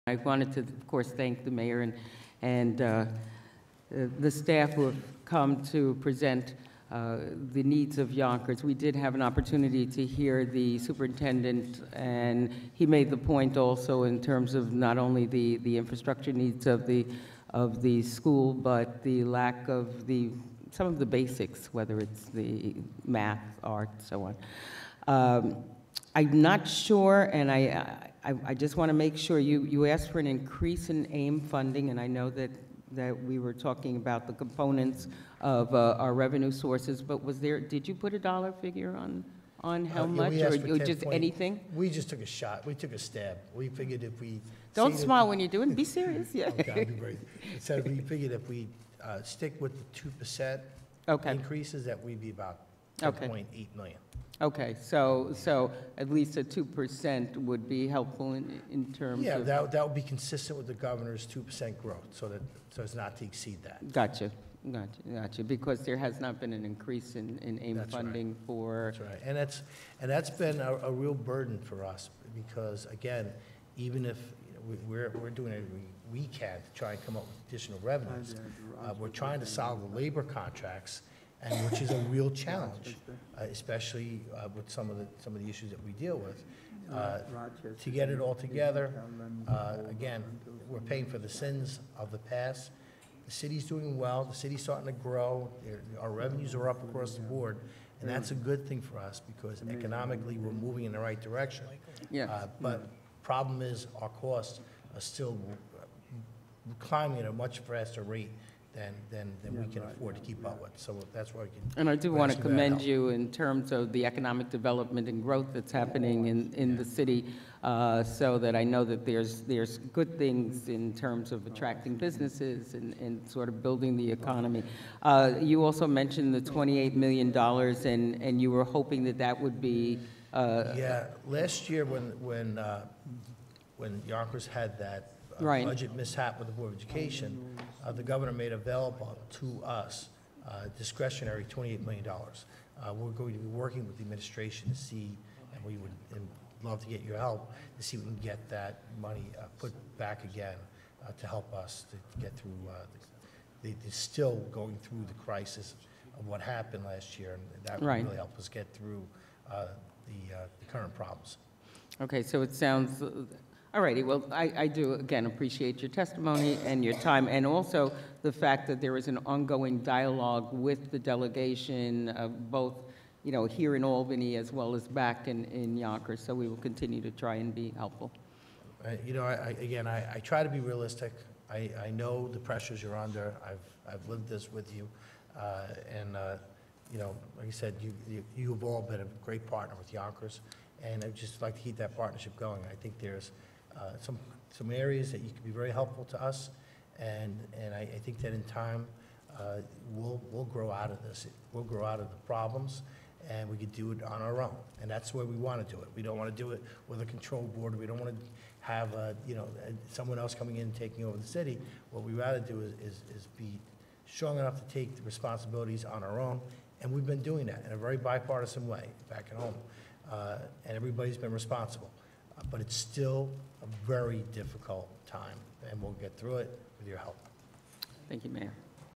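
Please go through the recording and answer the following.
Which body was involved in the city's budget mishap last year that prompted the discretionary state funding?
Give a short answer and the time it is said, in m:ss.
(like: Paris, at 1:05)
Board of Education, at 2:16.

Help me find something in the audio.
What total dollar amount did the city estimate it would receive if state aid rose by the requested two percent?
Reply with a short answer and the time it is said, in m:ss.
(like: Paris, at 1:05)
$10.8 million, at 0:53.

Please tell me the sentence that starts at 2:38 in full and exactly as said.
really help us get through uh, the uh, the current problems.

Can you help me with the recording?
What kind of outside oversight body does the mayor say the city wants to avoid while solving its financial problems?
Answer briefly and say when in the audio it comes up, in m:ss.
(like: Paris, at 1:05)
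A control board, at 3:27.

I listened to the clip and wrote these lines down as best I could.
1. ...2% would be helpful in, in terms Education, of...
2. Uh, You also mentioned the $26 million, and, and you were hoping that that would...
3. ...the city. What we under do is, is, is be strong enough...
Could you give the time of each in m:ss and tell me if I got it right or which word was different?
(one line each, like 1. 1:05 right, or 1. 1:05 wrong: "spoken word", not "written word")
1. 0:56 wrong: "Yeah", not "Education"
2. 2:05 wrong: "28", not "26"
3. 3:31 wrong: "rather", not "under".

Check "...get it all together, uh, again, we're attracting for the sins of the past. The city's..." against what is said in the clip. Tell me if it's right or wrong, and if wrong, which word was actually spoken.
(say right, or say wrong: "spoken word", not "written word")
wrong: "paying", not "attracting".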